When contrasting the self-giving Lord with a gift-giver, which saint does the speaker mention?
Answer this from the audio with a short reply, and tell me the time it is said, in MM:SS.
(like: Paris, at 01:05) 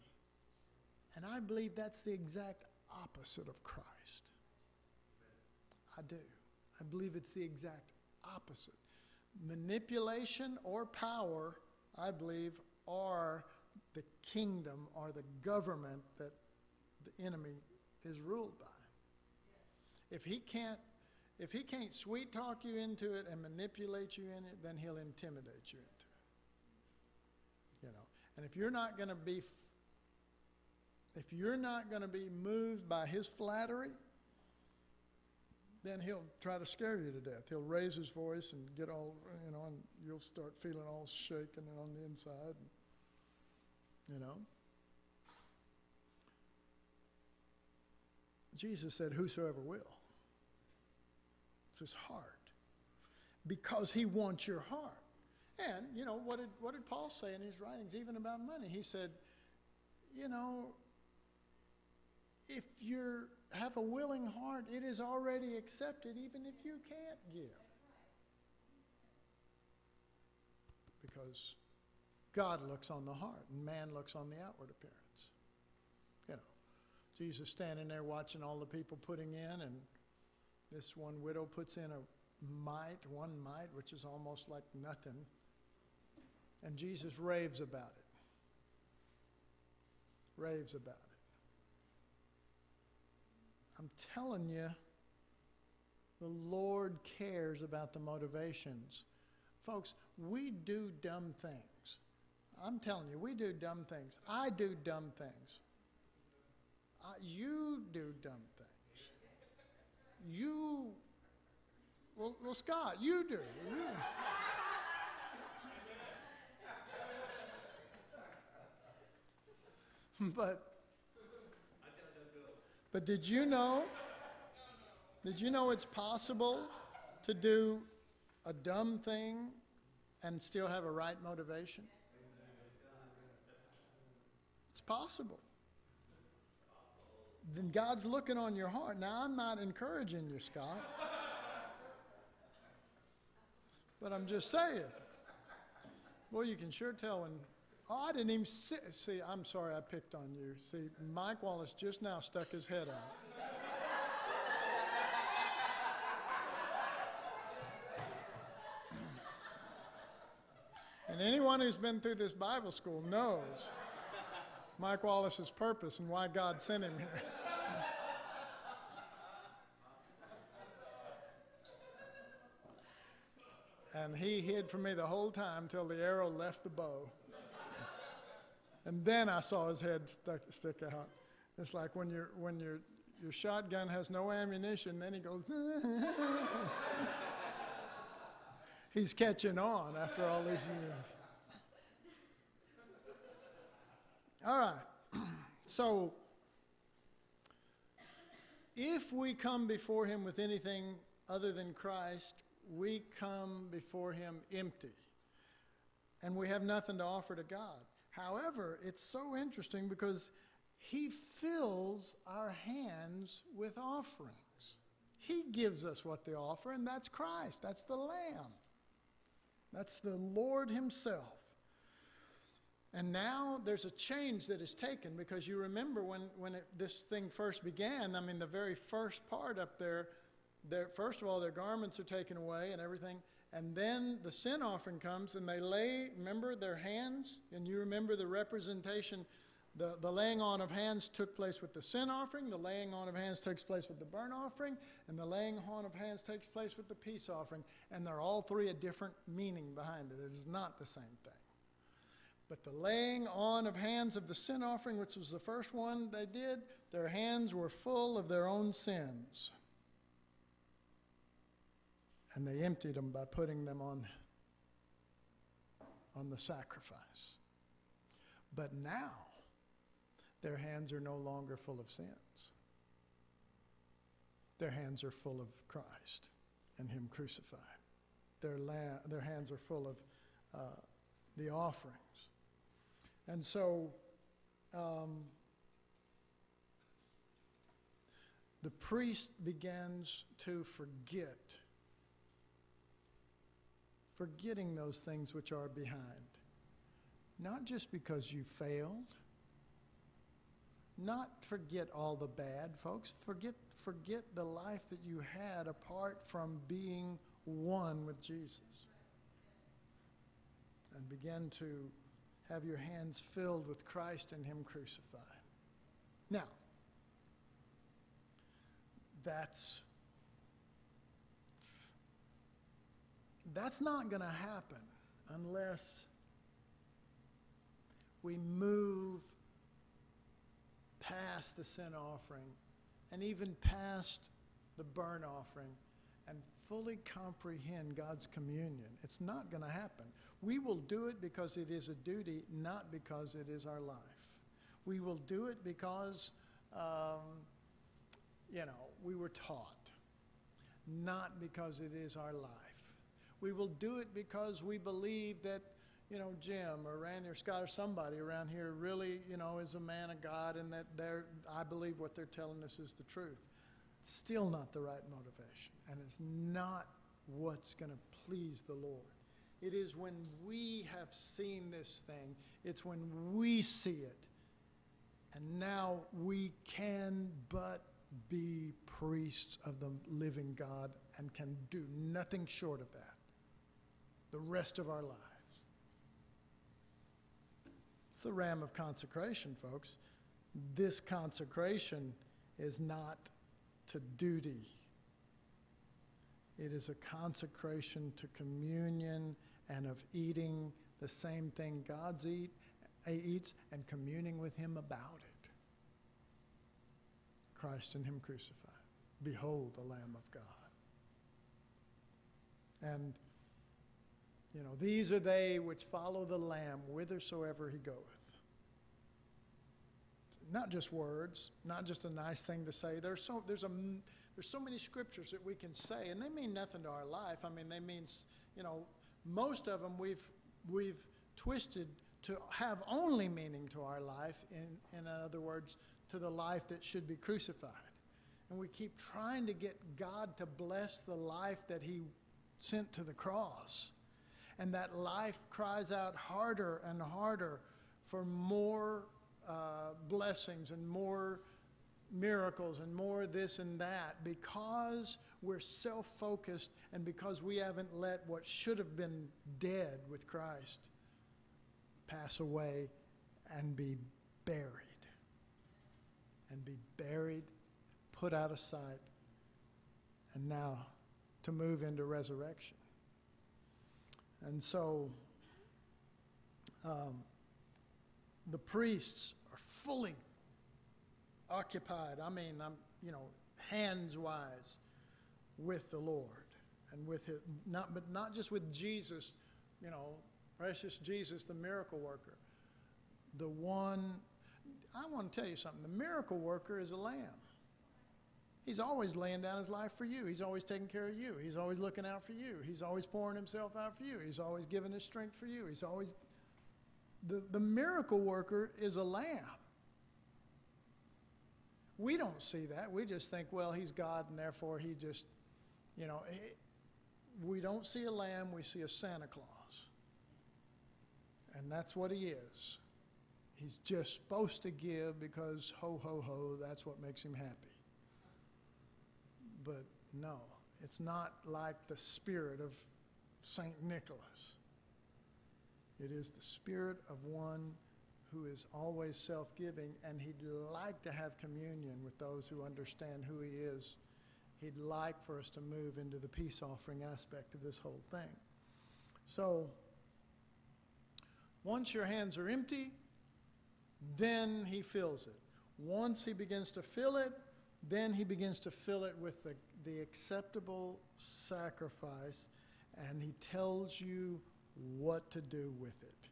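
St. Nicholas, at 08:53.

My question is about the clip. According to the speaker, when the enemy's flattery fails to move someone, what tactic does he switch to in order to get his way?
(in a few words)
intimidate.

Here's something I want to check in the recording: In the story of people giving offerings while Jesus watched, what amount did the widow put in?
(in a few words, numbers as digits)
one mite.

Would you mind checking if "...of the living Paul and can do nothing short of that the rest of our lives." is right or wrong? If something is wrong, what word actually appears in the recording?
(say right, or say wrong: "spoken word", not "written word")
wrong: "God", not "Paul".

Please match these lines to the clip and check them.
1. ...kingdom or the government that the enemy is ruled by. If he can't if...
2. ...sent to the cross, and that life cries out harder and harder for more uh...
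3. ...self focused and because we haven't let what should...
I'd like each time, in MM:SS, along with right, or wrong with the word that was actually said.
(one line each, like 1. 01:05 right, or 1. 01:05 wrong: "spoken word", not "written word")
1. 00:14 right
2. 07:22 right
3. 07:35 right.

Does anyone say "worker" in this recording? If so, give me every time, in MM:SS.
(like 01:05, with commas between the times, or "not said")
08:11, 08:16, 08:28.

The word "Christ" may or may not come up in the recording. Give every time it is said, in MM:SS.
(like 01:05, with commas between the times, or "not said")
00:03, 03:21, 03:37, 04:35, 05:13, 06:47, 07:40.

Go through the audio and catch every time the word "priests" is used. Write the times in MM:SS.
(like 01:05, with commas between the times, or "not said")
04:48, 06:18, 07:58.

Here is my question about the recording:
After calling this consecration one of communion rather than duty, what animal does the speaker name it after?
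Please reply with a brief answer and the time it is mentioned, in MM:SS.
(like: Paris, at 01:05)
ram, at 06:28.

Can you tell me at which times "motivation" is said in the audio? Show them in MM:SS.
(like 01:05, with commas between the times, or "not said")
01:37, 02:11, 06:05.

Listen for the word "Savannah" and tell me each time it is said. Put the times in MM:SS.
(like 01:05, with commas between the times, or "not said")
not said.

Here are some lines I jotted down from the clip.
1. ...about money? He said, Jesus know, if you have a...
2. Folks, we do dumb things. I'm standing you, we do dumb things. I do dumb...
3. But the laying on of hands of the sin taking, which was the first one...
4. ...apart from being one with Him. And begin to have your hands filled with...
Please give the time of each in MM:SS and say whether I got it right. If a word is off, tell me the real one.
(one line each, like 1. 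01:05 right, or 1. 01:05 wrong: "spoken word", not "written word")
1. 00:58 wrong: "You", not "Jesus"
2. 01:39 wrong: "telling", not "standing"
3. 04:12 wrong: "offering", not "taking"
4. 05:05 wrong: "Jesus", not "Him".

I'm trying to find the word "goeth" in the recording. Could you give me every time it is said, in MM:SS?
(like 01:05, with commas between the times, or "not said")
06:57.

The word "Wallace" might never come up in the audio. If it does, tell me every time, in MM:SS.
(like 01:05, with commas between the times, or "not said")
02:31, 02:45.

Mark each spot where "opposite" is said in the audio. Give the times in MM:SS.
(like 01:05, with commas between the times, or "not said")
00:03, 00:08.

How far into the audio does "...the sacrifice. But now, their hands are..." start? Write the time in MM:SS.
04:26.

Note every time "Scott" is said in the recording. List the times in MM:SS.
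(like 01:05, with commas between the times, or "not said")
01:52, 02:20, 05:57.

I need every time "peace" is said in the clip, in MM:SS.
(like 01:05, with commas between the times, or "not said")
04:06, 09:06.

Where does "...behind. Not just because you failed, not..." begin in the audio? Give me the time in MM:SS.
04:55.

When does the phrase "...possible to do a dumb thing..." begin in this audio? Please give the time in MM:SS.
02:05.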